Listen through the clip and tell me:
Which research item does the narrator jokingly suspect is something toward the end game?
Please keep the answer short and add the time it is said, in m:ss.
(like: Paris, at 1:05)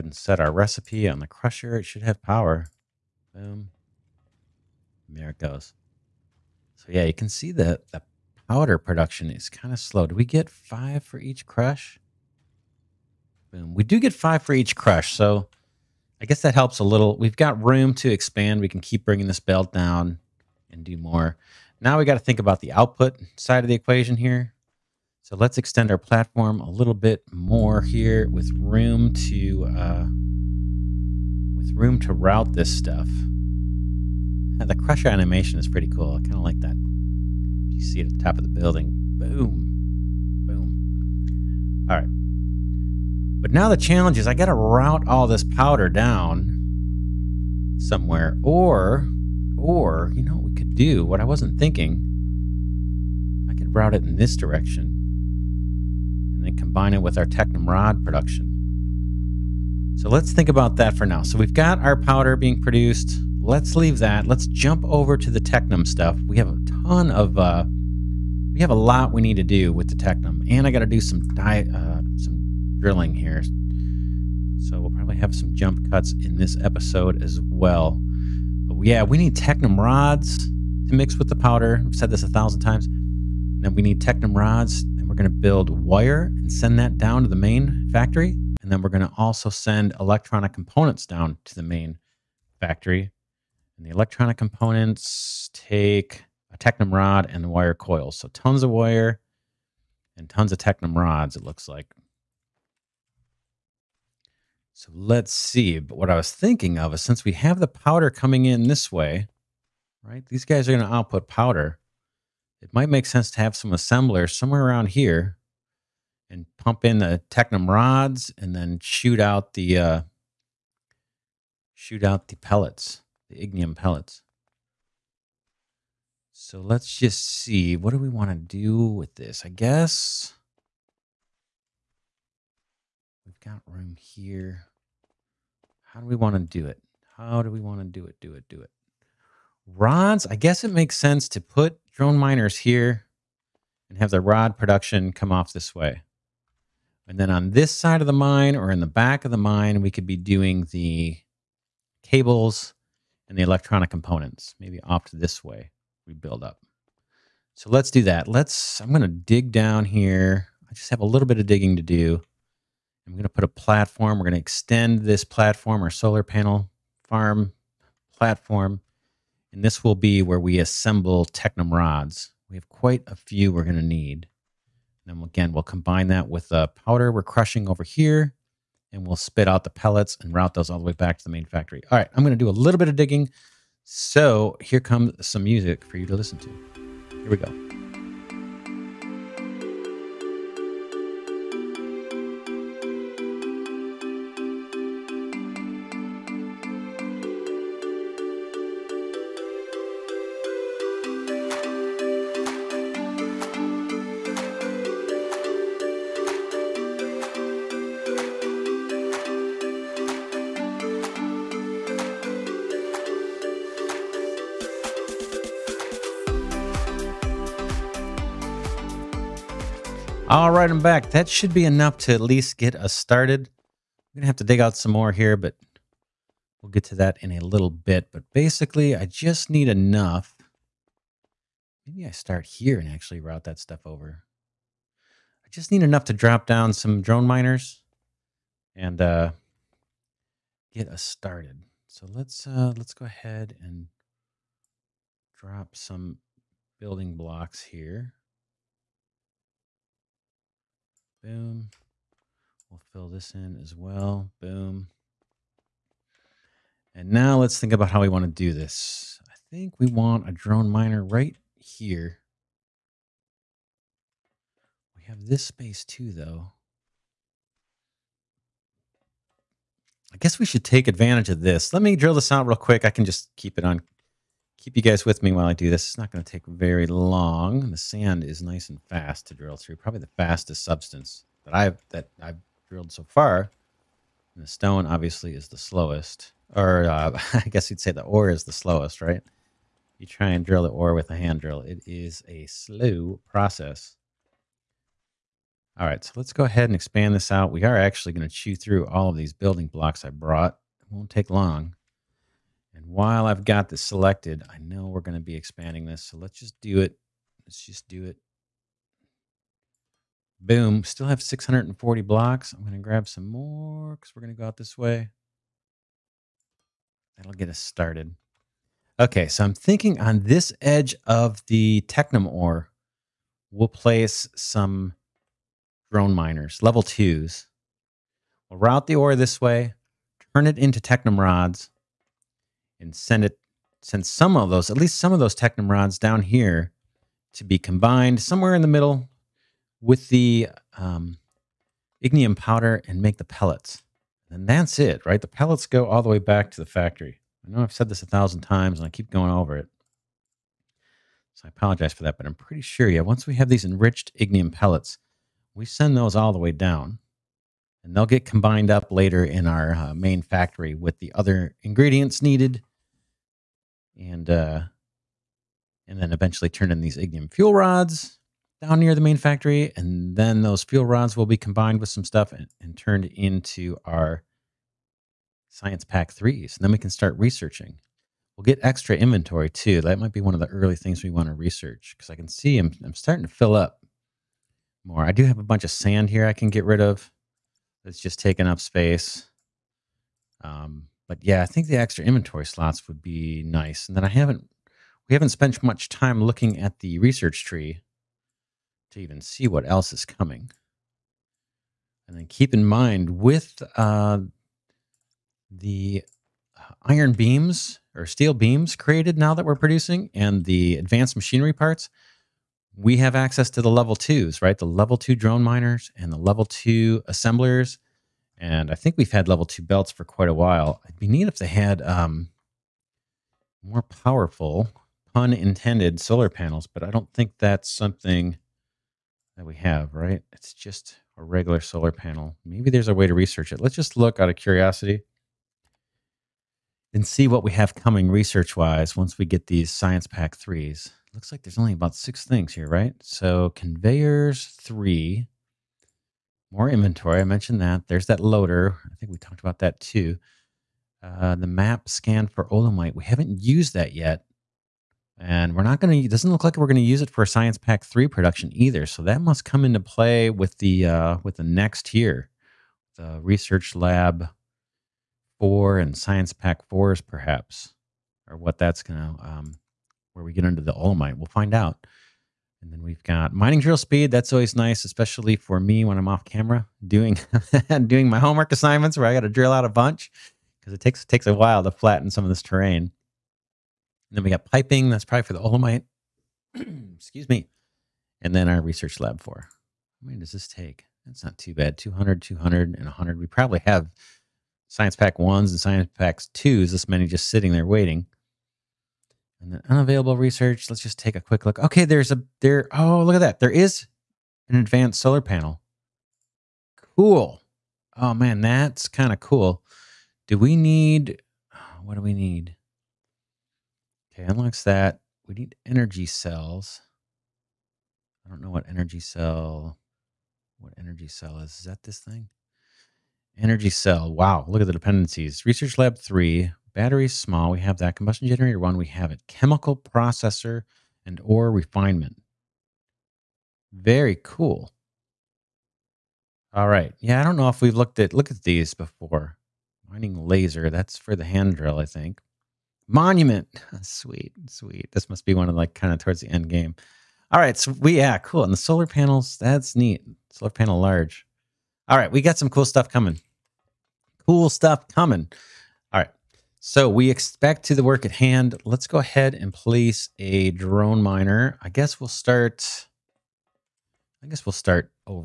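Monument, at 9:02.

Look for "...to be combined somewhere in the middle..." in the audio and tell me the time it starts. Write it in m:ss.
5:37.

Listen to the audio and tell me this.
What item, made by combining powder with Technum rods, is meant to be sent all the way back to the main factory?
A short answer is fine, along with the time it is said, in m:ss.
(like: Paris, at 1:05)
Enriched ignium pellets, at 5:53.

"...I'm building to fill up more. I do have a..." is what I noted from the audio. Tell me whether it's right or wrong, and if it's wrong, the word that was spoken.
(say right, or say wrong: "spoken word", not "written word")
wrong: "starting", not "building".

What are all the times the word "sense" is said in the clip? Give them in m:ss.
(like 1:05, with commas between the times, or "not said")
1:53, 2:20.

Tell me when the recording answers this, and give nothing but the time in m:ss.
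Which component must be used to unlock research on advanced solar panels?
8:35.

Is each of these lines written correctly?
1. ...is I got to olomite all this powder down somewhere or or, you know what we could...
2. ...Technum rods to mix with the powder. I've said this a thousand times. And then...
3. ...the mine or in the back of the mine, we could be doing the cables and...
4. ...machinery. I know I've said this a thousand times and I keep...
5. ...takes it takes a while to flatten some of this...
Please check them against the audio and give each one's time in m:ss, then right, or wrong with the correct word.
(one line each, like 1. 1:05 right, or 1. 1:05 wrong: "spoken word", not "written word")
1. 0:44 wrong: "route", not "olomite"
2. 1:19 right
3. 2:28 right
4. 5:46 wrong: "factory", not "machinery"
5. 8:00 right.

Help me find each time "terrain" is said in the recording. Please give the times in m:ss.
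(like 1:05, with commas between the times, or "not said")
8:02.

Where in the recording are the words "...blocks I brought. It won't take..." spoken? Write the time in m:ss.
4:59.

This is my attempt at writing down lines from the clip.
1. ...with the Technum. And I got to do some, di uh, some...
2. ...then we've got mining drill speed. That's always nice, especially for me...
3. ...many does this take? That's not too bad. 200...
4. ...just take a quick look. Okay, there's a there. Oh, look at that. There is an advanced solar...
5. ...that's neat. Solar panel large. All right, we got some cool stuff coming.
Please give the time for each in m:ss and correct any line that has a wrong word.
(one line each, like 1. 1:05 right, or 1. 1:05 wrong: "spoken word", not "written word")
1. 1:09 right
2. 7:52 right
3. 8:10 right
4. 8:20 right
5. 9:09 right.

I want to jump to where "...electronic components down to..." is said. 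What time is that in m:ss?
1:29.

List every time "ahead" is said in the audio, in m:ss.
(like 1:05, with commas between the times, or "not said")
4:03, 4:56, 9:18.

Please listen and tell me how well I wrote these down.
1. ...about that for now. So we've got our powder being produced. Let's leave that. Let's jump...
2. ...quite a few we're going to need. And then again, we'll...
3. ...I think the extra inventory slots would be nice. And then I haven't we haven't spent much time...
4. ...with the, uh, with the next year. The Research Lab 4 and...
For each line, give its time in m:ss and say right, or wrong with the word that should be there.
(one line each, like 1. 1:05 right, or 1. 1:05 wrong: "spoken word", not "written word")
1. 1:00 right
2. 2:52 right
3. 6:31 right
4. 7:40 right.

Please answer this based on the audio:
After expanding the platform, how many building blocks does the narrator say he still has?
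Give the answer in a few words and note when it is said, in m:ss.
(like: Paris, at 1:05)
640, at 5:11.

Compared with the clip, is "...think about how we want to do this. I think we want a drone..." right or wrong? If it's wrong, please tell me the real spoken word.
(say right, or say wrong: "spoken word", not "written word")
right.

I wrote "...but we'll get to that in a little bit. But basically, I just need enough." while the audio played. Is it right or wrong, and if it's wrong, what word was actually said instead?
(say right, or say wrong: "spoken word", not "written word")
right.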